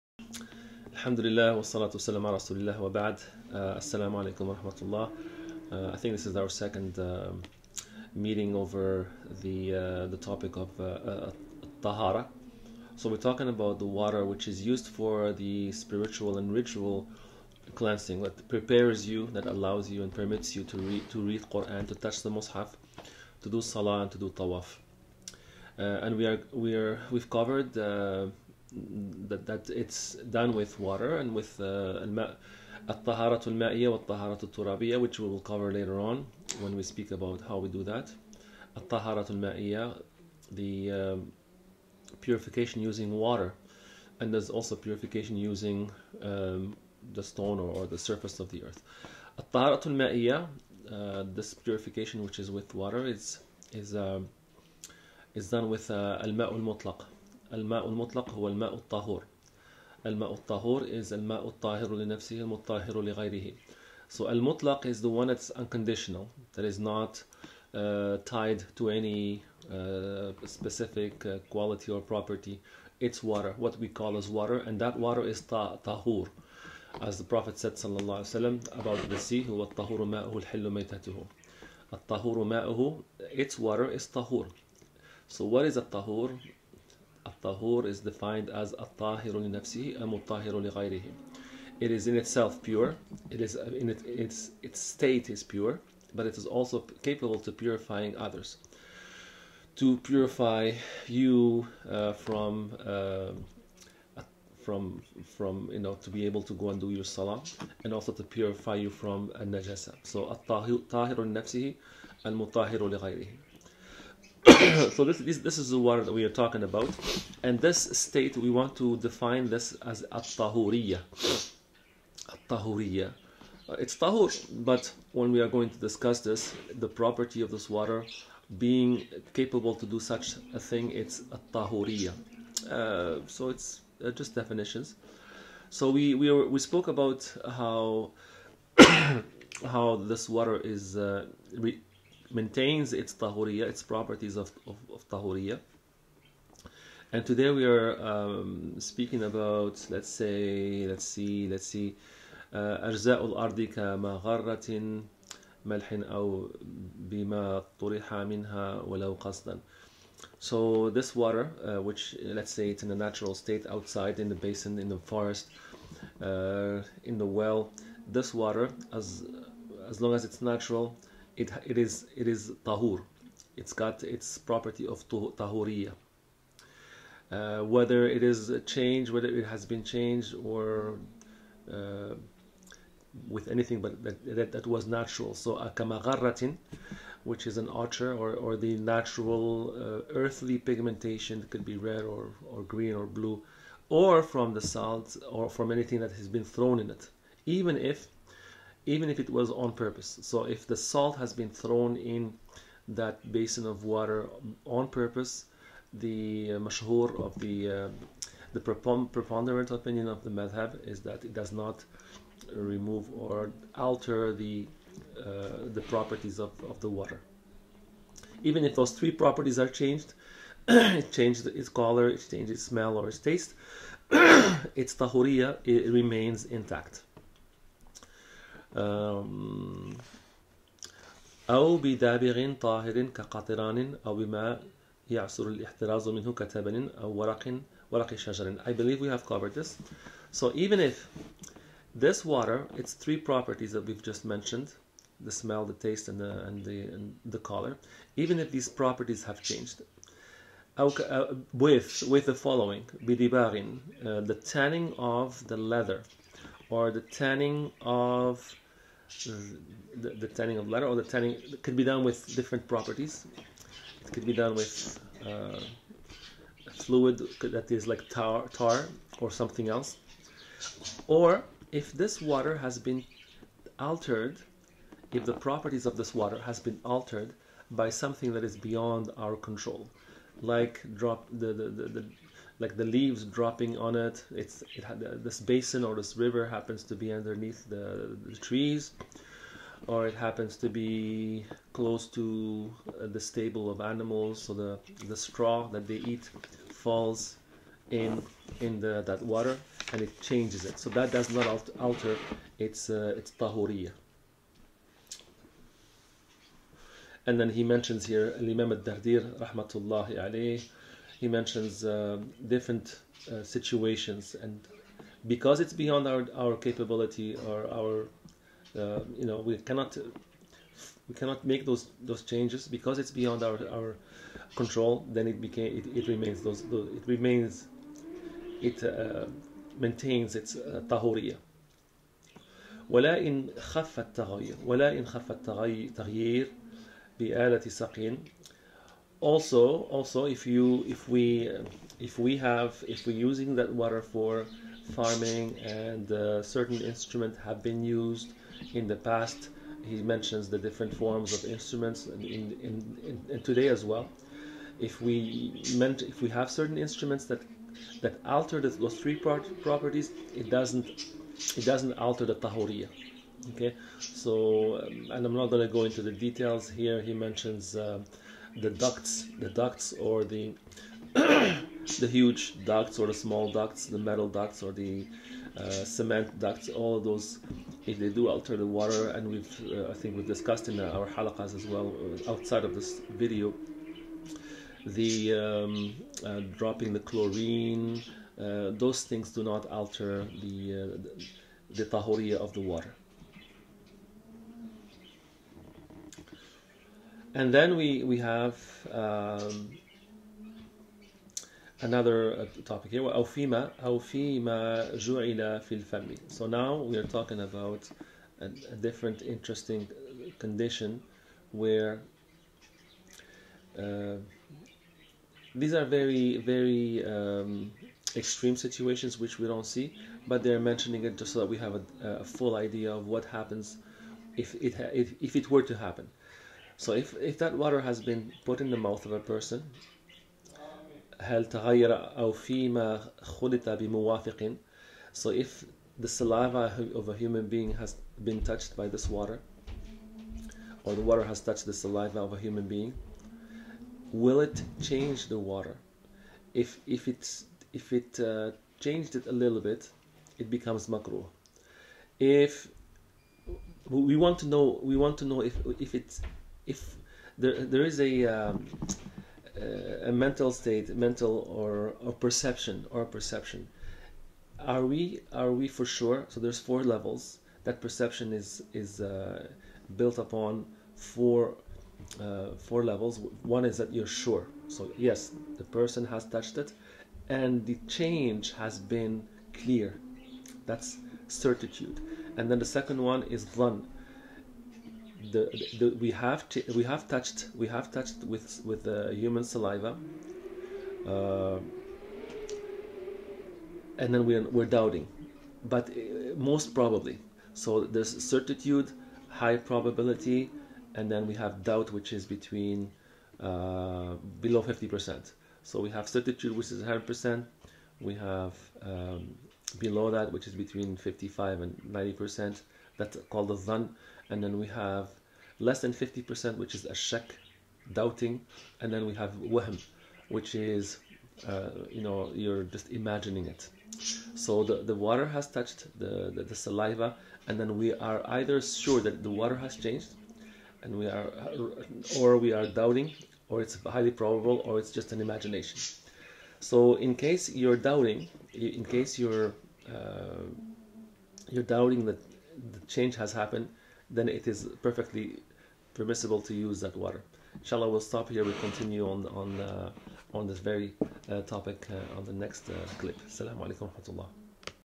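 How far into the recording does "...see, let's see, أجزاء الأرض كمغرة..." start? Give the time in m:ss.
2:31.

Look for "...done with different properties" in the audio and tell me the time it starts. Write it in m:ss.
4:21.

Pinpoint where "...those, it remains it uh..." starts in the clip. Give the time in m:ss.
5:26.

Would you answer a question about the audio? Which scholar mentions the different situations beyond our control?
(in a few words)
Imam al-Dardir.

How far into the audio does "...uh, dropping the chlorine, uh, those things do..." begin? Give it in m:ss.
6:26.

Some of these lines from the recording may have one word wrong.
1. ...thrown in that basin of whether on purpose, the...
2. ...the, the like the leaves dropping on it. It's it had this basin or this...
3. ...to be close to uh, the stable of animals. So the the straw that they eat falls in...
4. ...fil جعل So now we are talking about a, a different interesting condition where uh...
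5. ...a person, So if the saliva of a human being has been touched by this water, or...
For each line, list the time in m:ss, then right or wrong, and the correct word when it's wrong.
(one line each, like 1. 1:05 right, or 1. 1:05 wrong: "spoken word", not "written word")
1. 3:21 wrong: "water", not "whether"
2. 4:41 right
3. 4:50 right
4. 6:44 right
5. 7:09 right.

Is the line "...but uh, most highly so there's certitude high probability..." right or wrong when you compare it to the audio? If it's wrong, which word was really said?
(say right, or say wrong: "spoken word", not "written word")
wrong: "probably", not "highly".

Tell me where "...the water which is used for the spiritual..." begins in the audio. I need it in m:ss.
0:13.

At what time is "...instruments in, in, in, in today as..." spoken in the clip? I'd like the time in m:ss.
5:51.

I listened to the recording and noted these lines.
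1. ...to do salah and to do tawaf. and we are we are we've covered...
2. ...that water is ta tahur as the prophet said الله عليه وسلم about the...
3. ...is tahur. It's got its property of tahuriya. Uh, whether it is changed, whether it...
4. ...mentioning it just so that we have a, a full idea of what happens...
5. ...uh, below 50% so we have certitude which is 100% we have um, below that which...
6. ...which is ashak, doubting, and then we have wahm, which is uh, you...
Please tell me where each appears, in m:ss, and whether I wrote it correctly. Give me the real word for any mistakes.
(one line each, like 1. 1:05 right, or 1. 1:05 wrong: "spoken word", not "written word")
1. 0:23 right
2. 1:14 right
3. 2:52 right
4. 7:00 right
5. 8:23 right
6. 8:36 right.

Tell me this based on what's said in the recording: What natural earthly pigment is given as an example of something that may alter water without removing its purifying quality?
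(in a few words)
ochre.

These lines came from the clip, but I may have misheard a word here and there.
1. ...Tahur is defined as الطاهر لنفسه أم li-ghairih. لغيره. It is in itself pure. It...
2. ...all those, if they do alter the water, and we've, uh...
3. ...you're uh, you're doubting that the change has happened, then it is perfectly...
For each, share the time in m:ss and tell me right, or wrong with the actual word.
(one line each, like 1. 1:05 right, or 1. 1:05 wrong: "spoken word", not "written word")
1. 1:27 right
2. 6:16 right
3. 8:59 right.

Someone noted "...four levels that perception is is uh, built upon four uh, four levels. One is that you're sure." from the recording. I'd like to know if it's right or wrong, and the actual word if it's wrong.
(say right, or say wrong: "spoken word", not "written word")
right.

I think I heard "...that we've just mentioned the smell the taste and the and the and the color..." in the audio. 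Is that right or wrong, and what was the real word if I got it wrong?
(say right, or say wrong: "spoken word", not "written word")
right.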